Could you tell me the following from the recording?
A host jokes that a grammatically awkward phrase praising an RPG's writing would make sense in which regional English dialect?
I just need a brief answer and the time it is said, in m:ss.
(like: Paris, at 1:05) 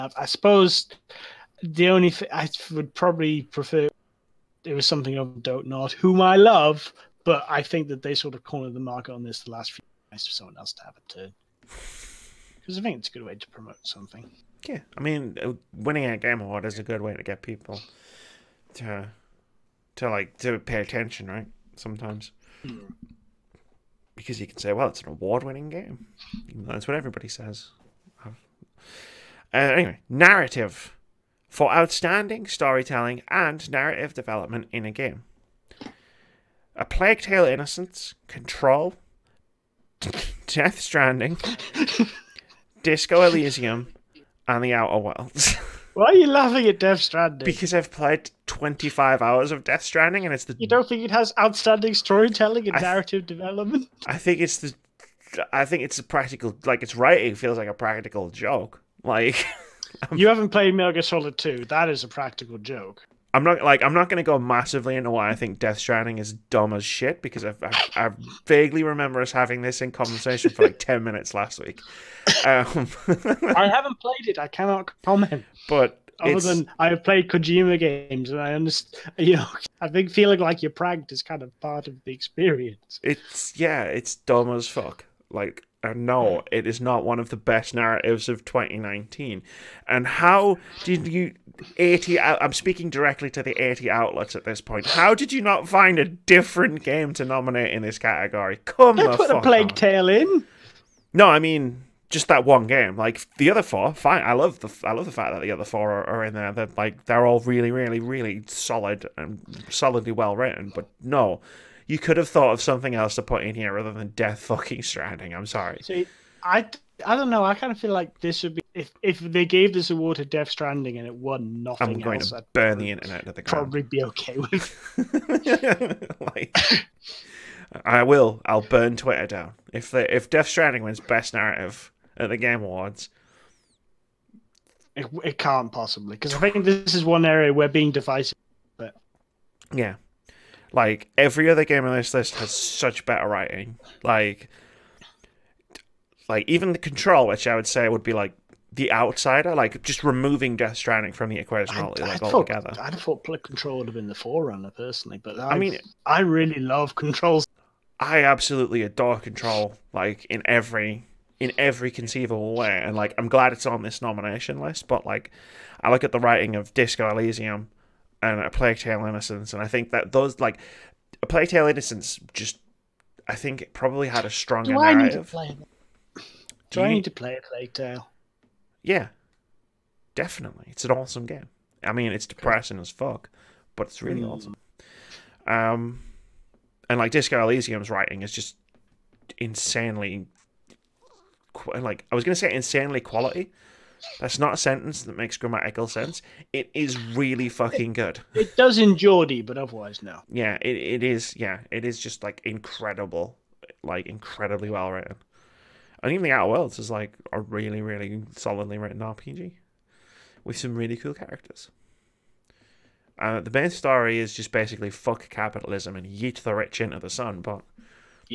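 Geordie, at 3:18.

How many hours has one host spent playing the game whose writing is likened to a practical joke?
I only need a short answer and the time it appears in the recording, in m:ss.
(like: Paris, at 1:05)
25, at 0:48.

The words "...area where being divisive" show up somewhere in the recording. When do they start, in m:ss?
2:17.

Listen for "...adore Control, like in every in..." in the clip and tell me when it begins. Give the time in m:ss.
2:38.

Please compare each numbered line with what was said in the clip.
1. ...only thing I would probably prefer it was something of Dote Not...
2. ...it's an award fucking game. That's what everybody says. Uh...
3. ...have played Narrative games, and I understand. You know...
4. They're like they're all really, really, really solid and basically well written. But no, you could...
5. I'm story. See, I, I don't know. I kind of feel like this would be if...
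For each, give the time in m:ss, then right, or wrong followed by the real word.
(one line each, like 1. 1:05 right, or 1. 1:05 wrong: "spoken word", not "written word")
1. 0:01 right
2. 0:24 wrong: "winning", not "fucking"
3. 1:16 wrong: "Kojima", not "Narrative"
4. 1:46 wrong: "solidly", not "basically"
5. 1:55 wrong: "sorry", not "story".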